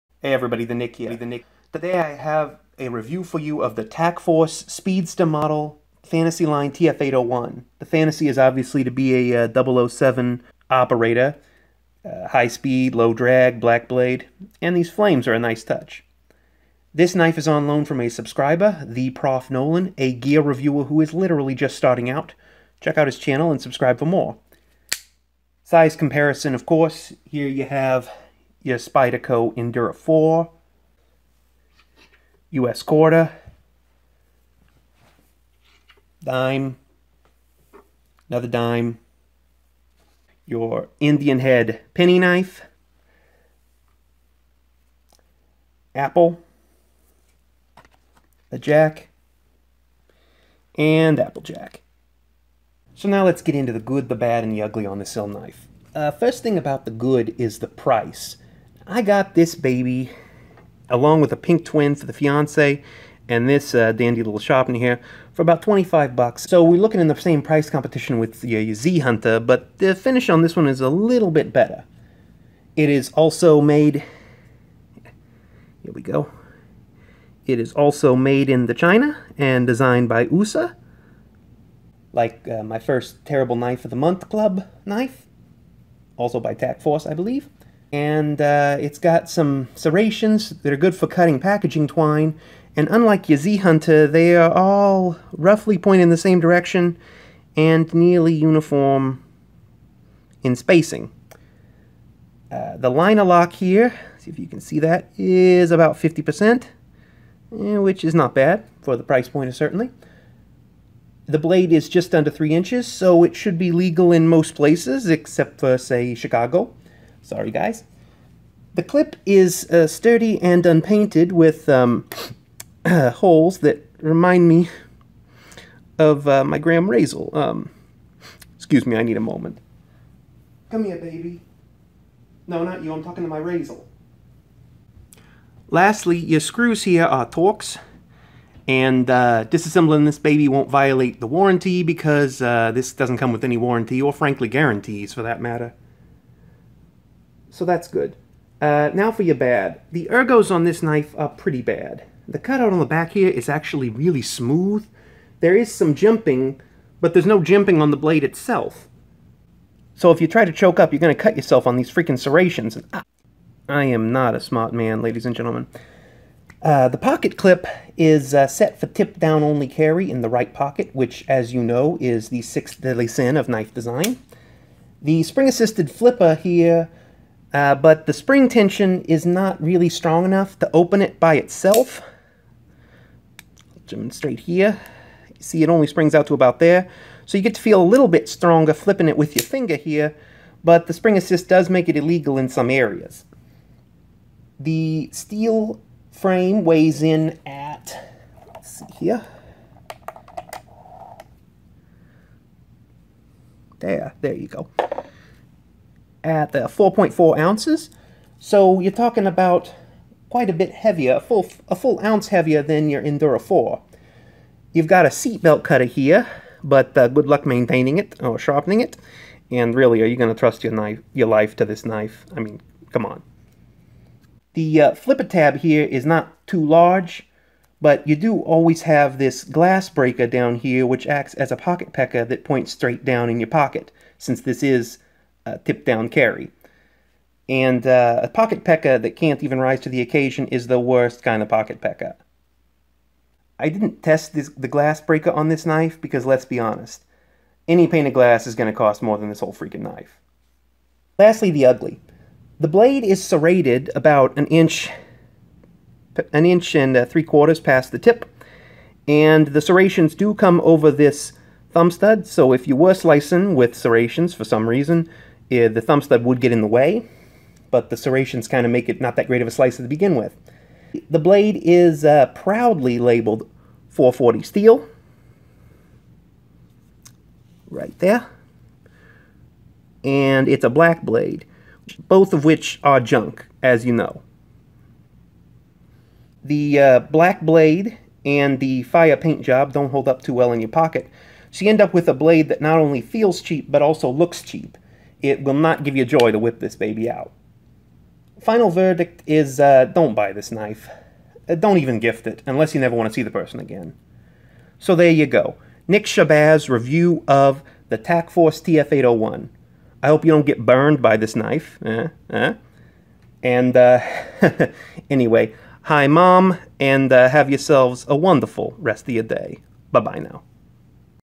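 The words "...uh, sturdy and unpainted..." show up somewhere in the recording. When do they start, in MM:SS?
01:59.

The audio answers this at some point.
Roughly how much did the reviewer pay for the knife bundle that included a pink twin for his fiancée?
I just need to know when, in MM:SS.
01:05.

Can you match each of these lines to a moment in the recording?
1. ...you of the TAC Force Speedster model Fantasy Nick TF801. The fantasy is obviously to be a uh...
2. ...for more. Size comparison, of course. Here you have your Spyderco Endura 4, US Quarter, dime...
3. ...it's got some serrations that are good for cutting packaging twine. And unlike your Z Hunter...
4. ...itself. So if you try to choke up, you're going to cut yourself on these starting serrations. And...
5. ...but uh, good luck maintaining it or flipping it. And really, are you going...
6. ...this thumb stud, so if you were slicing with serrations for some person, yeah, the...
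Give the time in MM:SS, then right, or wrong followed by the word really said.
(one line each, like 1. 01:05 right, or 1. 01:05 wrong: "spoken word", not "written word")
1. 00:03 wrong: "Line", not "Nick"
2. 00:23 right
3. 01:28 right
4. 02:38 wrong: "freaking", not "starting"
5. 03:36 wrong: "sharpening", not "flipping"
6. 04:20 wrong: "reason", not "person".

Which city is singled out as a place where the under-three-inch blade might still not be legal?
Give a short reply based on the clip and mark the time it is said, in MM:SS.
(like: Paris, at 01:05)
Chicago, at 01:56.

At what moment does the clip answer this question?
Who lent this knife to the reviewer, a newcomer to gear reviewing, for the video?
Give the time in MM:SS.
00:18.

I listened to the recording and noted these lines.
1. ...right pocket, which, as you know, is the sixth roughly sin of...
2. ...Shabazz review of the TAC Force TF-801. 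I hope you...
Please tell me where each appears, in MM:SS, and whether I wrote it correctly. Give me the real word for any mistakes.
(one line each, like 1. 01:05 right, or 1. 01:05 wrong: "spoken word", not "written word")
1. 02:50 wrong: "deadly", not "roughly"
2. 05:06 right.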